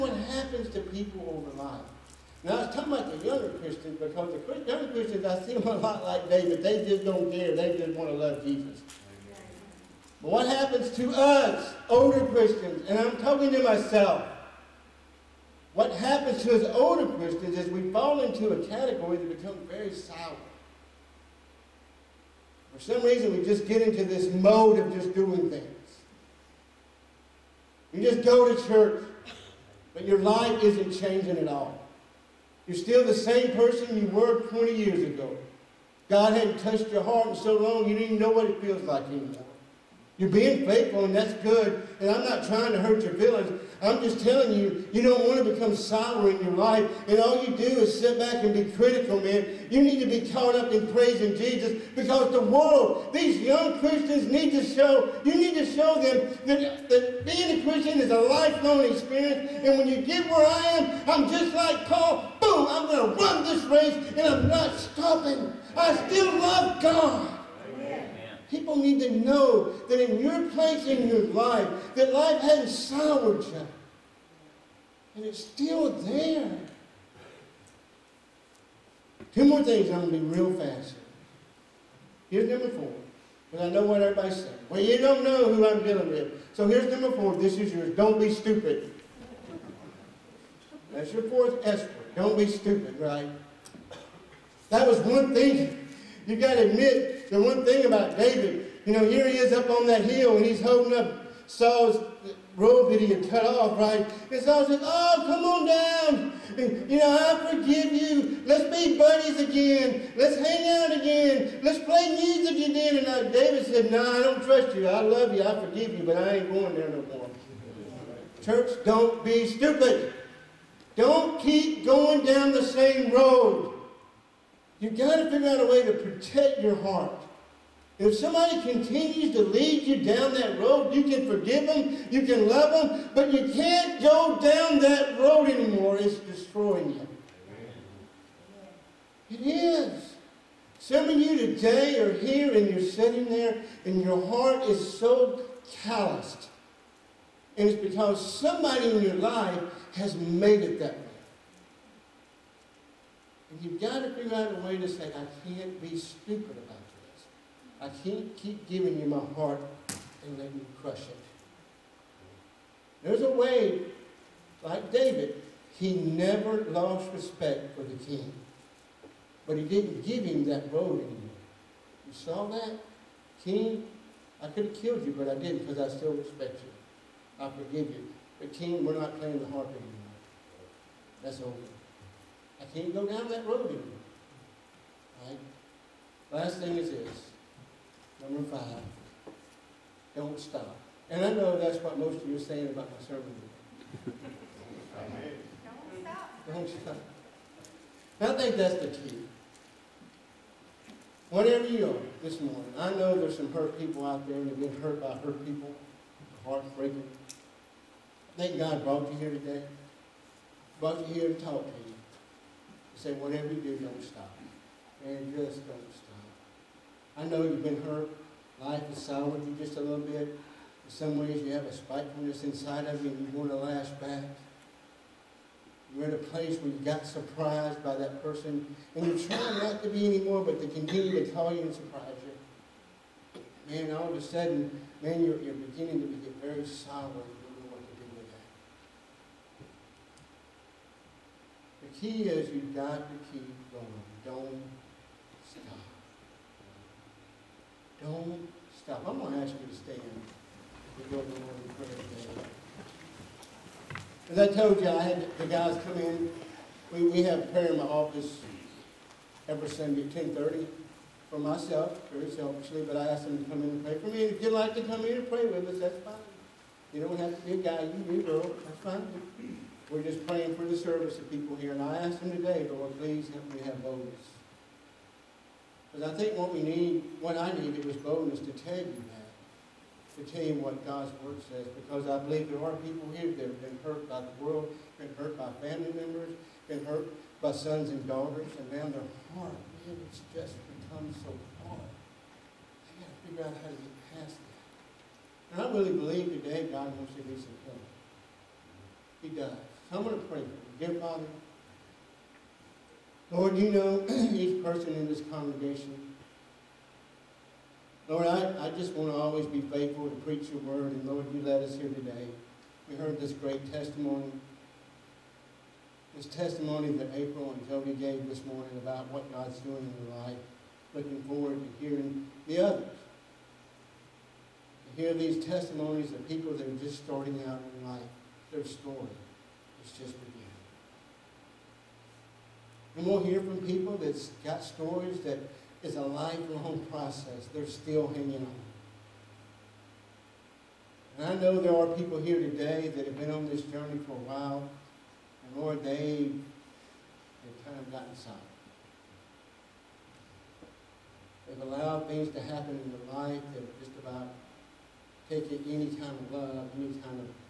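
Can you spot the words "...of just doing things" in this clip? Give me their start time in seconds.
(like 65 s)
24 s.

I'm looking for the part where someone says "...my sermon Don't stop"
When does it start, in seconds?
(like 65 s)
192 s.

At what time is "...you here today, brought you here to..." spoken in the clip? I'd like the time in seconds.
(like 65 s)
209 s.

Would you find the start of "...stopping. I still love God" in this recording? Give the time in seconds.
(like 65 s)
64 s.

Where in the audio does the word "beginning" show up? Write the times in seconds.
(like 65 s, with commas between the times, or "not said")
235 s, 330 s.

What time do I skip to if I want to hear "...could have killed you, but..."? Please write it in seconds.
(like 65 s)
174 s.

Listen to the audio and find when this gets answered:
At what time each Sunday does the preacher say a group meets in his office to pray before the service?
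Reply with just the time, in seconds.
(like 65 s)
260 s.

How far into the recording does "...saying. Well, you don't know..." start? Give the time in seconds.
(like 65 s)
84 s.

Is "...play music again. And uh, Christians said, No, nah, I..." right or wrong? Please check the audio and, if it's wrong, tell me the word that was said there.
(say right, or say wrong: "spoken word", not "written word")
wrong: "David", not "Christians".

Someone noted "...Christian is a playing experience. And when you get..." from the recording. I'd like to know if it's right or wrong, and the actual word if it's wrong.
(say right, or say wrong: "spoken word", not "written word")
wrong: "lifelong", not "playing".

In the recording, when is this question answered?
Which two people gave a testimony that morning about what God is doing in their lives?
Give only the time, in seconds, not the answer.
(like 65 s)
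317 s.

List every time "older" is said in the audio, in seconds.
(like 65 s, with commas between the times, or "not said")
11 s, 16 s.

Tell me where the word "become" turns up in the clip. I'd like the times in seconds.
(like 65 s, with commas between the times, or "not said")
19 s, 45 s, 290 s.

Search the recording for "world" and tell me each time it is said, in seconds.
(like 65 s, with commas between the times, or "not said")
52 s, 284 s.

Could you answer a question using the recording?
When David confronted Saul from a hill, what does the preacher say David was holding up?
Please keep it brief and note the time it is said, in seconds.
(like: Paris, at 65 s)
Saul's robe, at 101 s.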